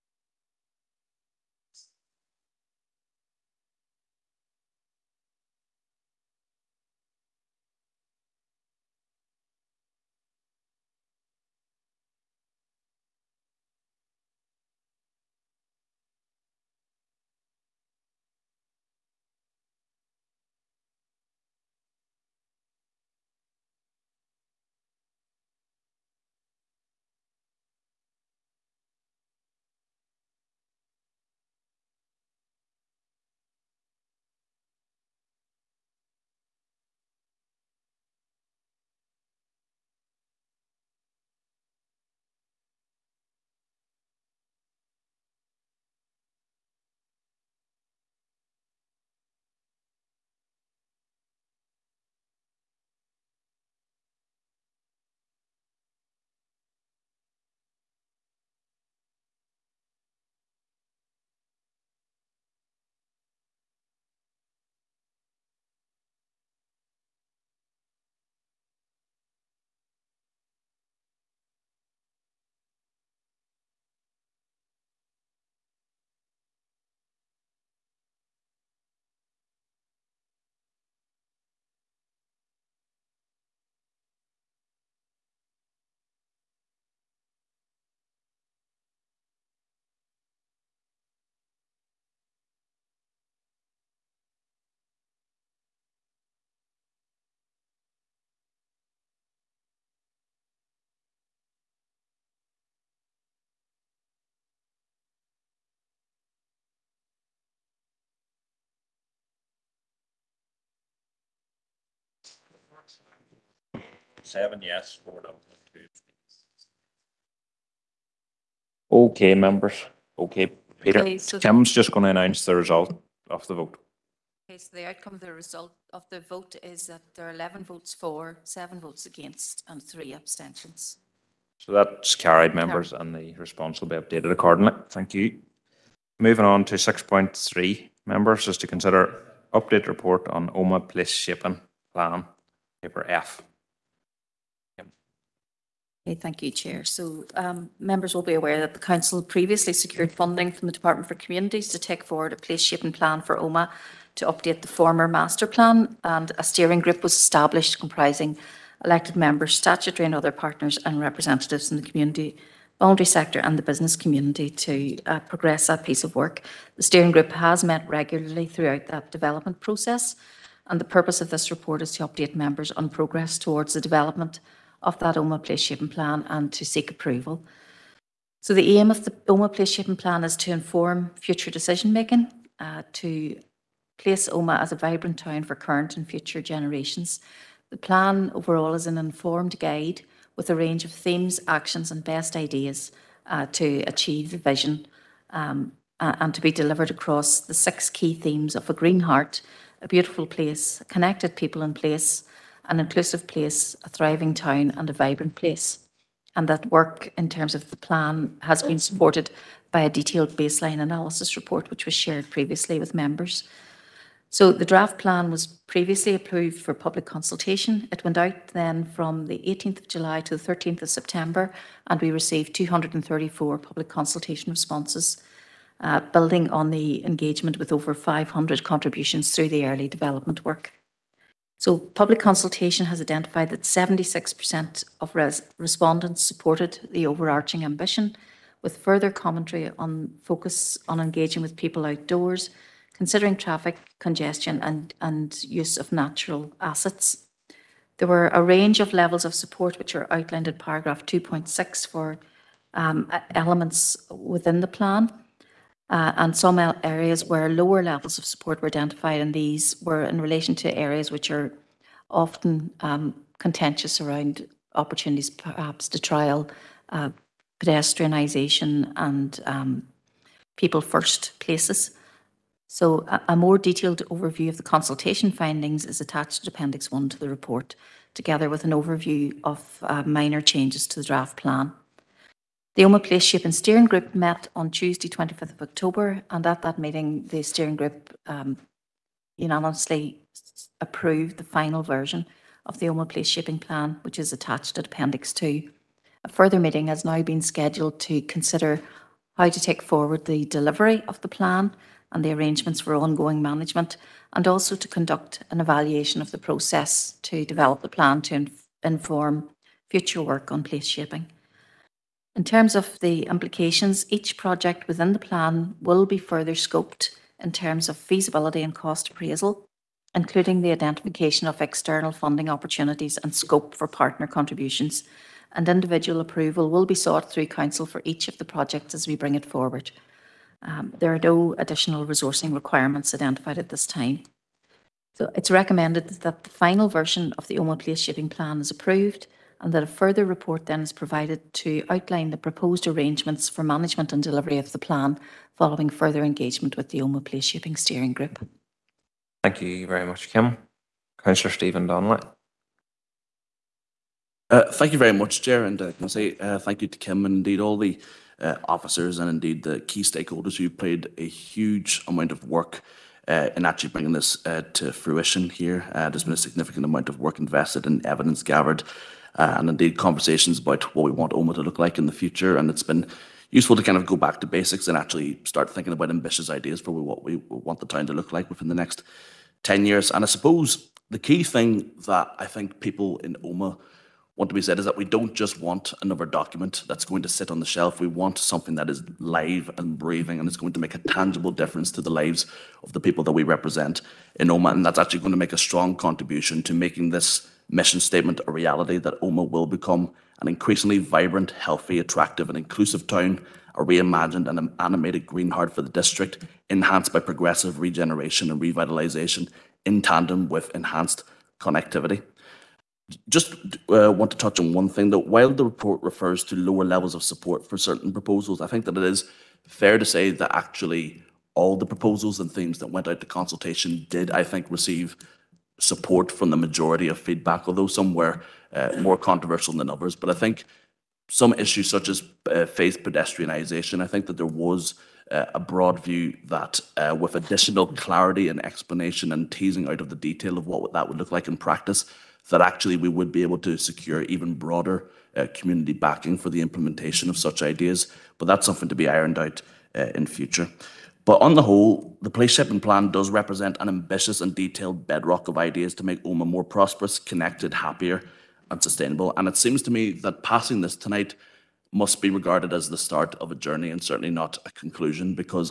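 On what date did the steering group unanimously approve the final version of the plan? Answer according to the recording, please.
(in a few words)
Tuesday, 25th of October.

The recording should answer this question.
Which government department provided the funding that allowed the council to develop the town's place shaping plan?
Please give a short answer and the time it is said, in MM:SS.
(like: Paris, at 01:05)
Department for Communities, at 02:30.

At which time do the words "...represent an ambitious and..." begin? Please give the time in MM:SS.
07:33.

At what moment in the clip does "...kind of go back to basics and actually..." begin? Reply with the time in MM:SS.
06:13.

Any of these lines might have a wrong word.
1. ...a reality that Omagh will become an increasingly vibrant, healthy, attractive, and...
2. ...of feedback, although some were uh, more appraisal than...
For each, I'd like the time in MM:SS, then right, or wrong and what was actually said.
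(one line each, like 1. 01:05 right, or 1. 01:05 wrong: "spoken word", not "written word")
1. 06:38 right
2. 07:07 wrong: "controversial", not "appraisal".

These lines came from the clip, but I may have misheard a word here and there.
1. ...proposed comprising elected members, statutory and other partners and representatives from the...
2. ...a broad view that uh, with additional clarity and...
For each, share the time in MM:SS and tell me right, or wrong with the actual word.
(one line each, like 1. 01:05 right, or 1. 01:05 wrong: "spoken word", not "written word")
1. 02:37 wrong: "established", not "proposed"
2. 07:15 right.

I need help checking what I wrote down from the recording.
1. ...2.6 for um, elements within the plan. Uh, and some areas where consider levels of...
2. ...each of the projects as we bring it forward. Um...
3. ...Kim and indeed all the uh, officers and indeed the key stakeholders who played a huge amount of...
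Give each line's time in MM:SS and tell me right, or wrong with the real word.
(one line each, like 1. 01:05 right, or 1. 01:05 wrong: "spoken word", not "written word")
1. 04:11 wrong: "lower", not "consider"
2. 05:28 right
3. 05:56 right.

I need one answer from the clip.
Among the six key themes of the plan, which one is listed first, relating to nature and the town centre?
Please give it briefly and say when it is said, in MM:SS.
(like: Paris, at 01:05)
a green heart, at 03:18.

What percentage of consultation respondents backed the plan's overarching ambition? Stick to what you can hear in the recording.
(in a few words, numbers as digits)
76%.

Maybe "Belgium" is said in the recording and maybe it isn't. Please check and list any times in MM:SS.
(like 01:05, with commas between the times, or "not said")
not said.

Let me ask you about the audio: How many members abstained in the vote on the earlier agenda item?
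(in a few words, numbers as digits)
3.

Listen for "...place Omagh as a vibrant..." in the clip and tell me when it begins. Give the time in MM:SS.
03:03.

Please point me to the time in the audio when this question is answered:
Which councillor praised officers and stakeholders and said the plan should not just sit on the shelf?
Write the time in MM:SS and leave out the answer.
05:51.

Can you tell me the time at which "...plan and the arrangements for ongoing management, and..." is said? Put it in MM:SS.
05:01.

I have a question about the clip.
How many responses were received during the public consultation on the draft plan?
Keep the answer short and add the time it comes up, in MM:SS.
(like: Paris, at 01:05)
234, at 03:42.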